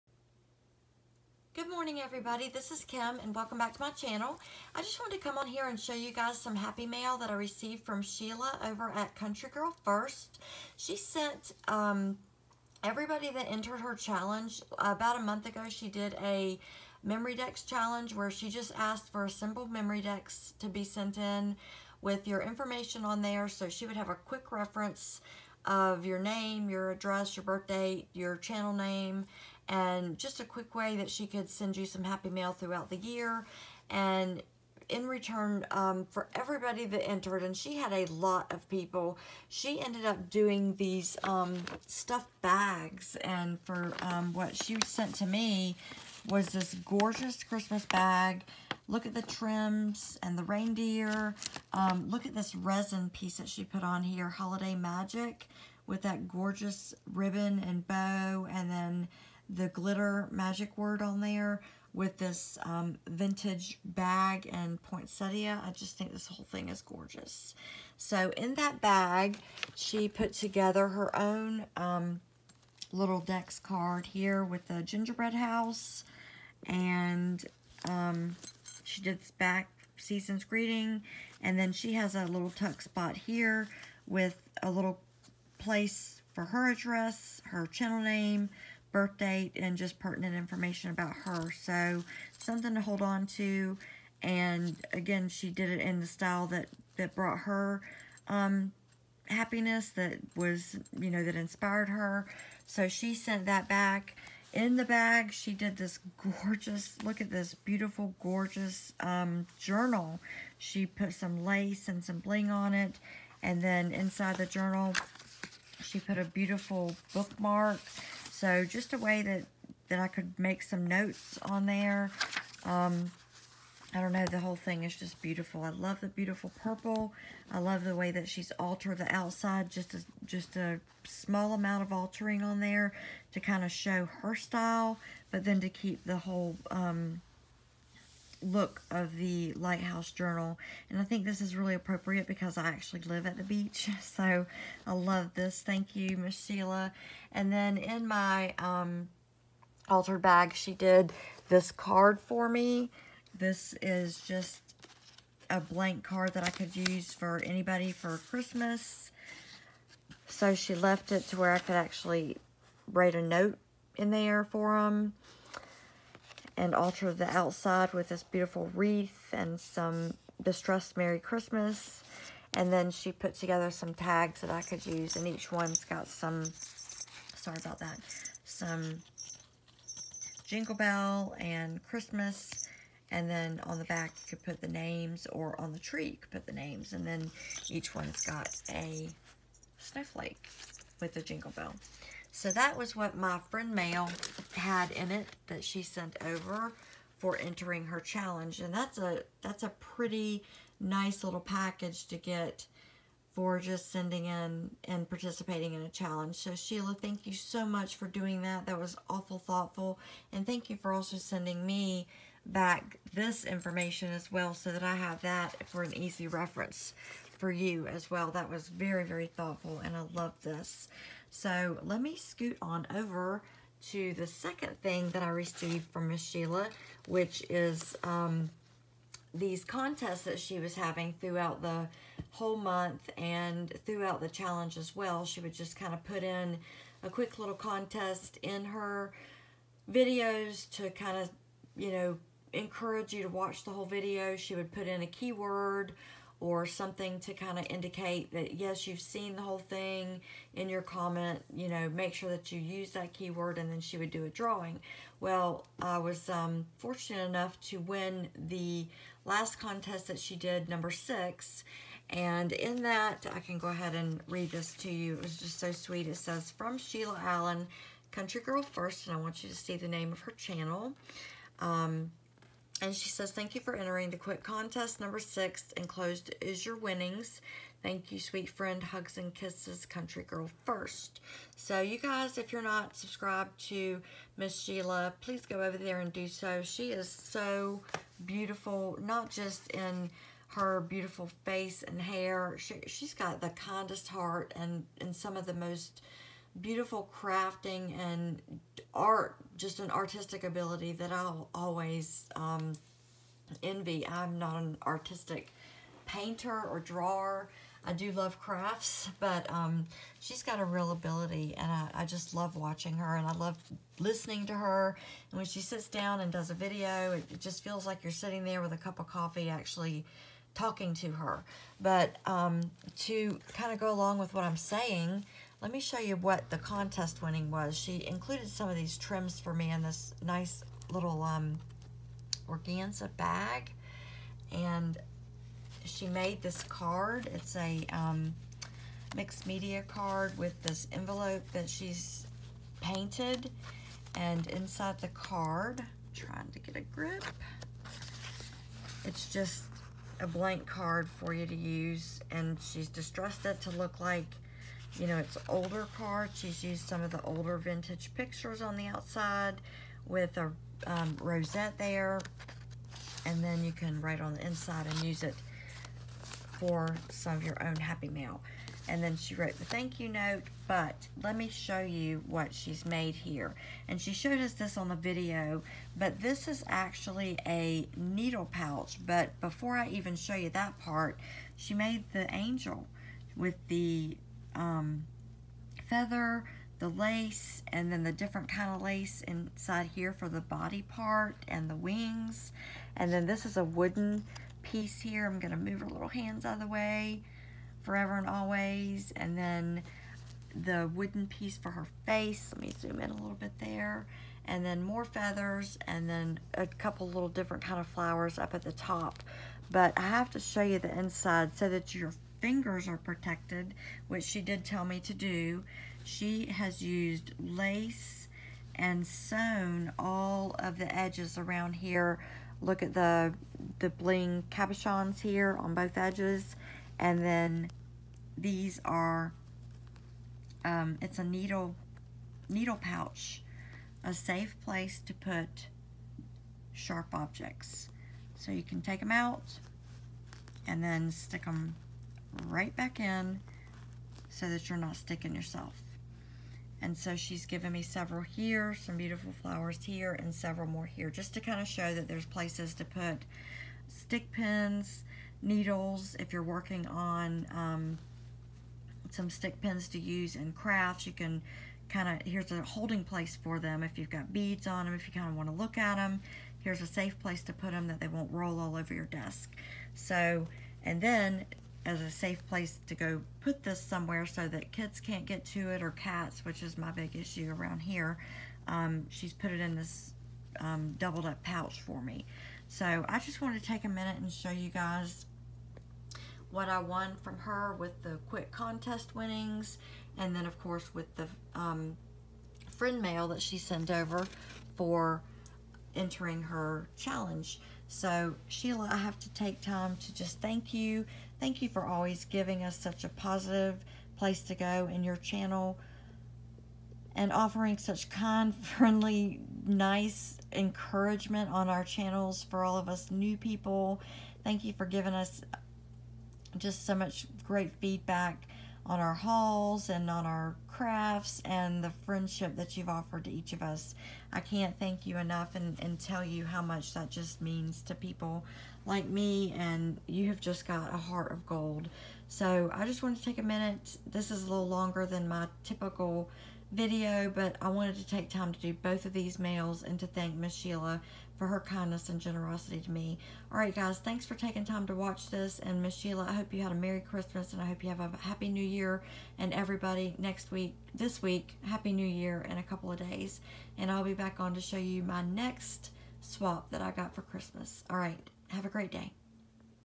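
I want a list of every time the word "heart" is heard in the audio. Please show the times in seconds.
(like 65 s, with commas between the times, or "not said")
294 s, 530 s.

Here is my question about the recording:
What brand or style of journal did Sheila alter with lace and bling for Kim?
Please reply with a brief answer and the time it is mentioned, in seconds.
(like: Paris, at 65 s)
Lighthouse Journal, at 139 s.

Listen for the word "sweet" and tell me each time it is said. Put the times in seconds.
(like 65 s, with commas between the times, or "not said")
265 s, 278 s.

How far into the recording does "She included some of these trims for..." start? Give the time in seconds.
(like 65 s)
327 s.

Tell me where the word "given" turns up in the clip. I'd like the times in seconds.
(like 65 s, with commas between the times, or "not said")
447 s.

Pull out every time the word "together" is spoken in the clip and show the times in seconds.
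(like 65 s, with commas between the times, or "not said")
70 s, 173 s.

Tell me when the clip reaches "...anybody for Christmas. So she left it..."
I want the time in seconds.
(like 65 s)
157 s.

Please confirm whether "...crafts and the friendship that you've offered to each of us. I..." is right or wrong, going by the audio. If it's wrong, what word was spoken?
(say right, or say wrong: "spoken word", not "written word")
right.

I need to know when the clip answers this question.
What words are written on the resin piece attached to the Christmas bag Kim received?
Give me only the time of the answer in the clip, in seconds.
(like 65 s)
54 s.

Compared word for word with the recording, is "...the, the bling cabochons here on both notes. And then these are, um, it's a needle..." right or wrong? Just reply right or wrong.
wrong.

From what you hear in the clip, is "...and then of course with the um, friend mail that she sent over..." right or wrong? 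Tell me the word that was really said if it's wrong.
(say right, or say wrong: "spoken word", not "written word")
right.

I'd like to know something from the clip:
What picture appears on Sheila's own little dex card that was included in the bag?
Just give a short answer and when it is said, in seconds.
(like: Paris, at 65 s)
gingerbread house, at 74 s.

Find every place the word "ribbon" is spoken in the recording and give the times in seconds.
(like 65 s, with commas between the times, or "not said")
57 s.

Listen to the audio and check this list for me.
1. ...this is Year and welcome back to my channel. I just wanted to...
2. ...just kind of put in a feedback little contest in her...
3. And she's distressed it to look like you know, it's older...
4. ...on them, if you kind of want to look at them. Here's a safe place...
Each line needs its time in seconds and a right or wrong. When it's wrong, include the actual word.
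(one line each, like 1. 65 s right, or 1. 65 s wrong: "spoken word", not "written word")
1. 2 s wrong: "Kim", not "Year"
2. 235 s wrong: "quick", not "feedback"
3. 352 s right
4. 464 s right.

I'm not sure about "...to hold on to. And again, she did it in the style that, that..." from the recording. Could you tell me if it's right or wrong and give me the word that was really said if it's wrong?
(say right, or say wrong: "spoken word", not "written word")
right.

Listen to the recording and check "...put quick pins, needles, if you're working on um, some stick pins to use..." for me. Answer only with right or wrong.
wrong.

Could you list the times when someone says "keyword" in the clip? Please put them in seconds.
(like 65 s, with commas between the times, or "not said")
245 s, 253 s.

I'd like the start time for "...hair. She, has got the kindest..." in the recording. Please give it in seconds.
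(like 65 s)
292 s.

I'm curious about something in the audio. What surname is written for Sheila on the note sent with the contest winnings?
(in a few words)
Allen.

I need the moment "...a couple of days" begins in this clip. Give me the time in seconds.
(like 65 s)
552 s.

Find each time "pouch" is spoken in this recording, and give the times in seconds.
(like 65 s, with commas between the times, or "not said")
378 s, 432 s, 481 s.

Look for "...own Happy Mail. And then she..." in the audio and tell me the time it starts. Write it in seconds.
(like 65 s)
367 s.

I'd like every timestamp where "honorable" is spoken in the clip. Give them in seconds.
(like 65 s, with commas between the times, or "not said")
not said.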